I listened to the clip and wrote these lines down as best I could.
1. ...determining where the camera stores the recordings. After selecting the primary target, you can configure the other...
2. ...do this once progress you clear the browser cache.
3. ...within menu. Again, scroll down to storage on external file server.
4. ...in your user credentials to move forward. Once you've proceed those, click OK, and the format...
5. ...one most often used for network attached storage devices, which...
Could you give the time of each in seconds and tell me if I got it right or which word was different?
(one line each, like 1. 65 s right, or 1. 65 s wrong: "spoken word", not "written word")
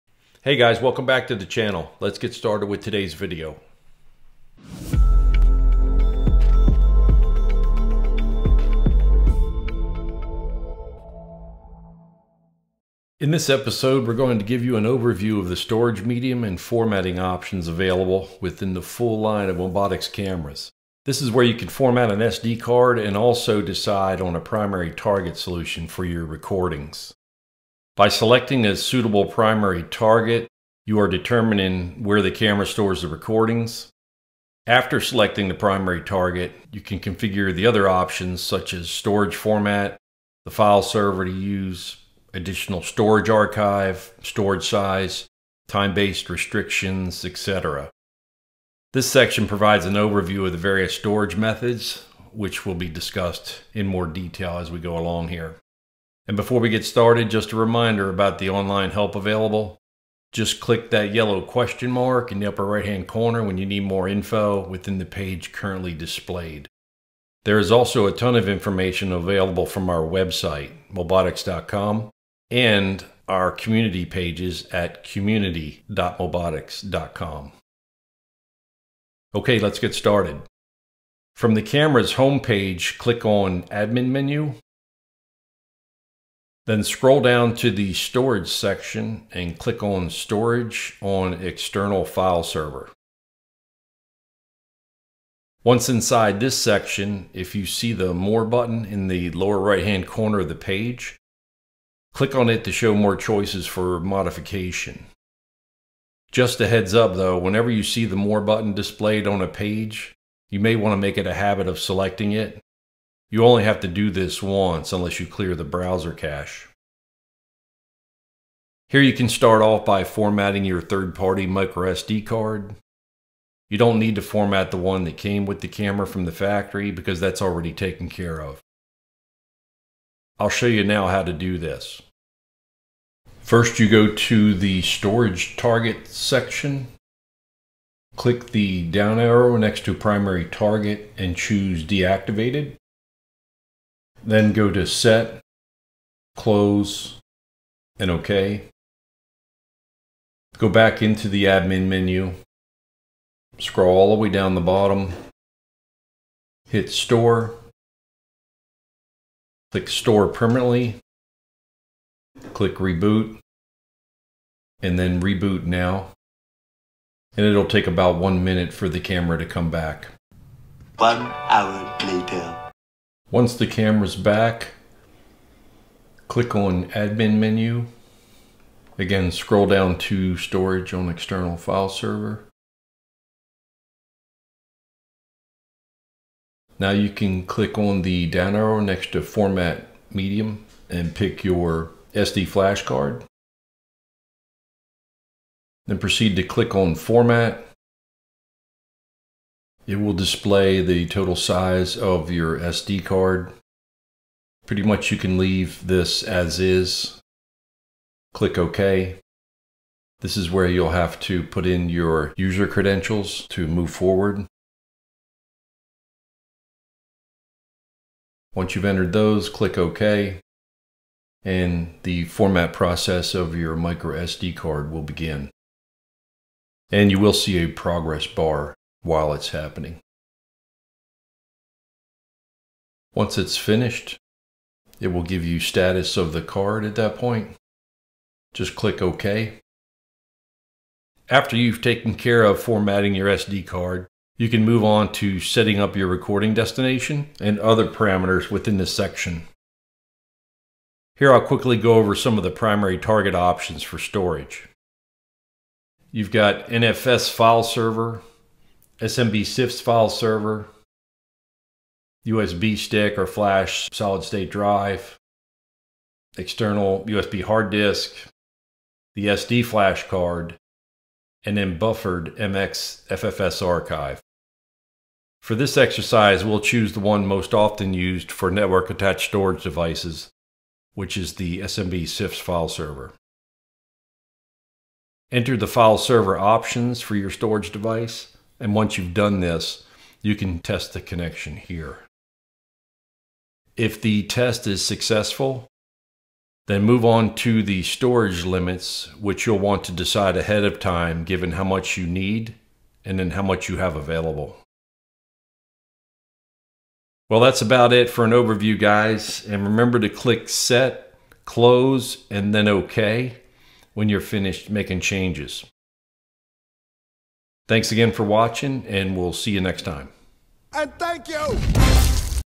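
1. 31 s right
2. 113 s wrong: "unless", not "progress"
3. 176 s wrong: "admin", not "within"
4. 211 s wrong: "entered", not "proceed"
5. 276 s right.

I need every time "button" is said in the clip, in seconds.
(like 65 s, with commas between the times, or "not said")
98 s, 108 s.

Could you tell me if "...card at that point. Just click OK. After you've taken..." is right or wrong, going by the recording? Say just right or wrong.
right.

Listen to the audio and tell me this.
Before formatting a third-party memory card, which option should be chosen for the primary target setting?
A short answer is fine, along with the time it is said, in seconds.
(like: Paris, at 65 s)
Deactivated, at 141 s.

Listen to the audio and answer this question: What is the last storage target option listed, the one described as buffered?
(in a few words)
MX FFS archive.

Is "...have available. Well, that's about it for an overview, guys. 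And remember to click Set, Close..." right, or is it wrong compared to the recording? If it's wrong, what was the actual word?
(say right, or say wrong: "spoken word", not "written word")
right.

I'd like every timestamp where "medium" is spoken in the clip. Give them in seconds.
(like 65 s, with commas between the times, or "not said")
16 s, 190 s.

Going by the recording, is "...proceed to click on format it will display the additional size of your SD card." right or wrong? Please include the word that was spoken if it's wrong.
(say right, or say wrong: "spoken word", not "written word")
wrong: "total", not "additional".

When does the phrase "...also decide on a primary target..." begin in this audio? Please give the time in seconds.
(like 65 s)
23 s.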